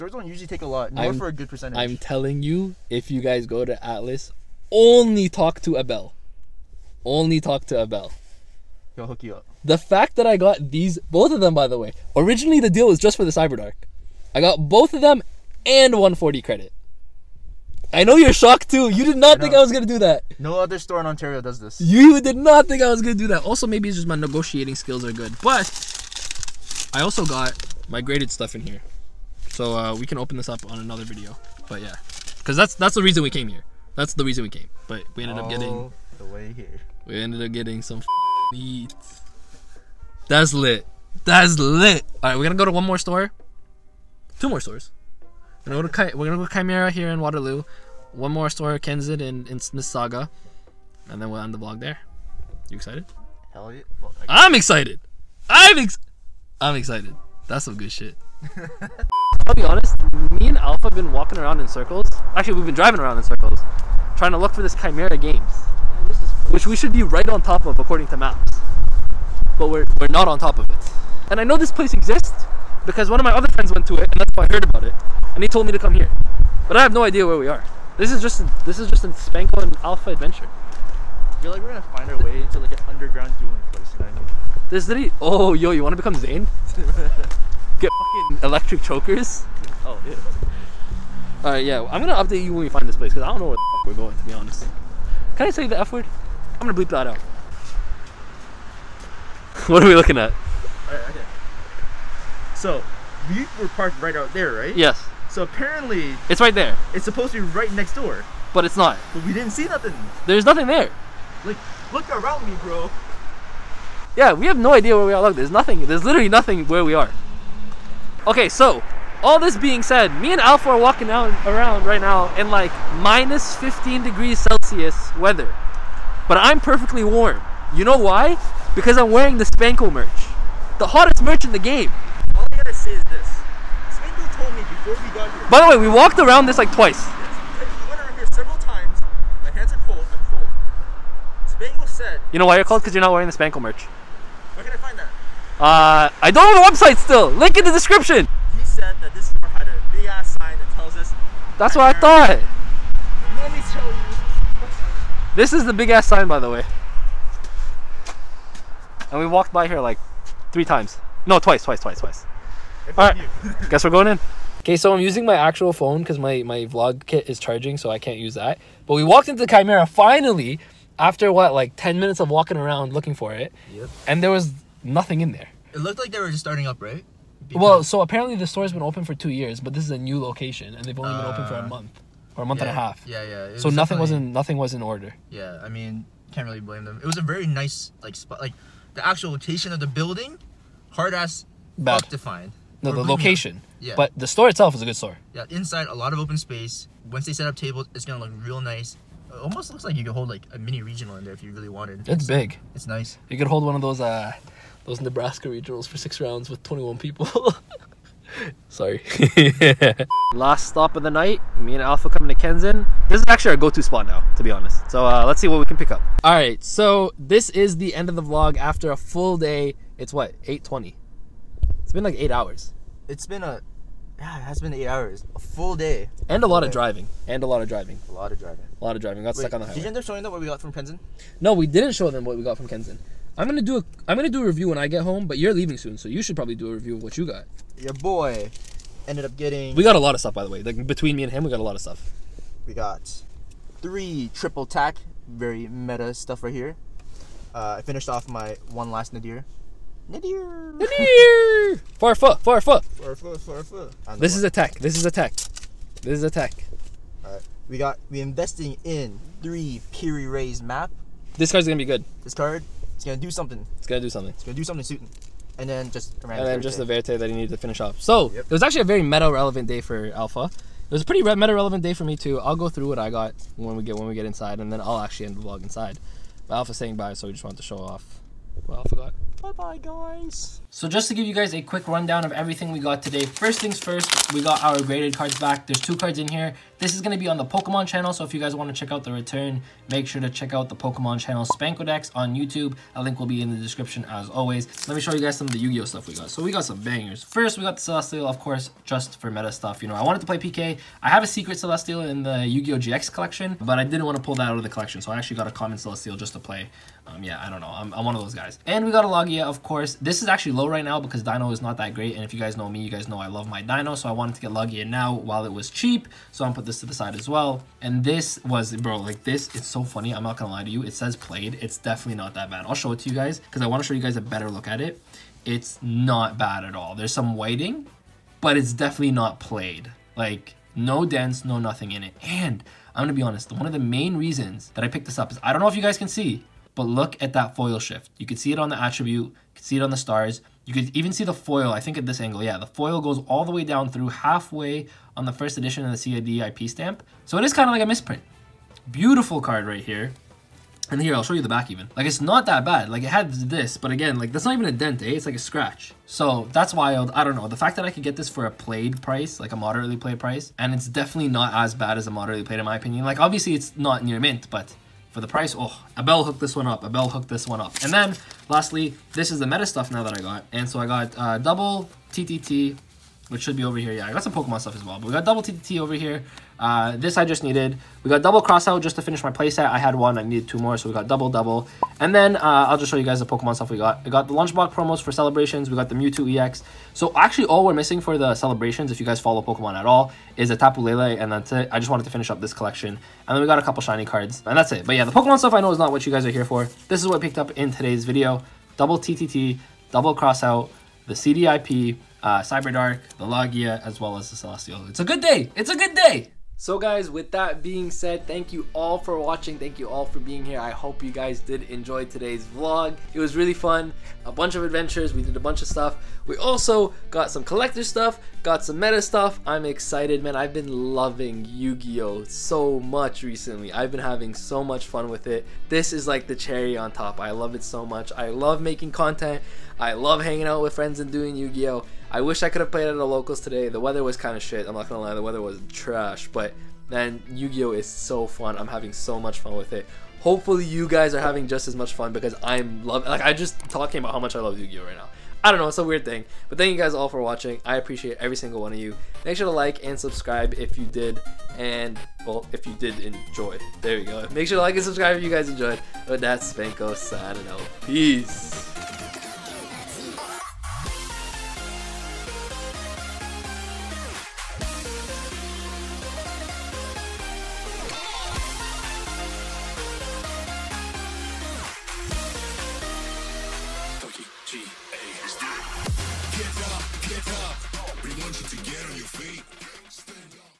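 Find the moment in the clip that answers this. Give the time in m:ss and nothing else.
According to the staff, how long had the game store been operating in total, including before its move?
2:59.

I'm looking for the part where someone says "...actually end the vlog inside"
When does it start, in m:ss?
4:34.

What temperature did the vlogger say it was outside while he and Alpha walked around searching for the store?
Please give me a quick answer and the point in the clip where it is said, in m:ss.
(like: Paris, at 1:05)
minus 15 degrees Celsius, at 2:02.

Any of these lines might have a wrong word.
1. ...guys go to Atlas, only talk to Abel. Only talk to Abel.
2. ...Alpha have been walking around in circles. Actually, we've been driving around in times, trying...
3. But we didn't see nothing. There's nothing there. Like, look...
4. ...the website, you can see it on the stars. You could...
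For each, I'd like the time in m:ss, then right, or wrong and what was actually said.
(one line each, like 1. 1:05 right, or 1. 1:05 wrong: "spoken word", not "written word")
1. 0:03 right
2. 1:00 wrong: "circles", not "times"
3. 1:49 right
4. 5:38 wrong: "attribute", not "website".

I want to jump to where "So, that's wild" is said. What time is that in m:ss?
5:56.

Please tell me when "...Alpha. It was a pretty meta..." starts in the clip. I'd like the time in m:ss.
4:30.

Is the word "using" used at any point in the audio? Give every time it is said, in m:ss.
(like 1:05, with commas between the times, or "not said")
2:45.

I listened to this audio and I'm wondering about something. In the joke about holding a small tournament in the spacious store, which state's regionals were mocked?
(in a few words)
Nebraska.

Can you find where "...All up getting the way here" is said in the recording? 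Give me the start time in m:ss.
0:35.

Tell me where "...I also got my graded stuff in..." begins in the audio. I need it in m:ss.
0:26.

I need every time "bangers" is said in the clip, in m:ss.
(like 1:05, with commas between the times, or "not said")
4:56.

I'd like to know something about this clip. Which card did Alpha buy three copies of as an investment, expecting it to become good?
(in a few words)
Piri Reis map.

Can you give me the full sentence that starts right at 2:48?
But we walked into the Chimera finally after what, like 10 minutes of walking around looking for it.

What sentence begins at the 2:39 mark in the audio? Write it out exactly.
And we walked by here like three times.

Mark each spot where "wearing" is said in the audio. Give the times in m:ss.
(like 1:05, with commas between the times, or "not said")
2:09, 2:23.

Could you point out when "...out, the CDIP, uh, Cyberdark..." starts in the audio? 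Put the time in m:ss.
6:40.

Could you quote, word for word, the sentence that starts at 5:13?
So I wanted to get Lugia now while it was cheap.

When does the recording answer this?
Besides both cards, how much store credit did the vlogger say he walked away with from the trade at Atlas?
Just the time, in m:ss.
0:15.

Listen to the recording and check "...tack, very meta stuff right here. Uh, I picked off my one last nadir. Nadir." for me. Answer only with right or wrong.
wrong.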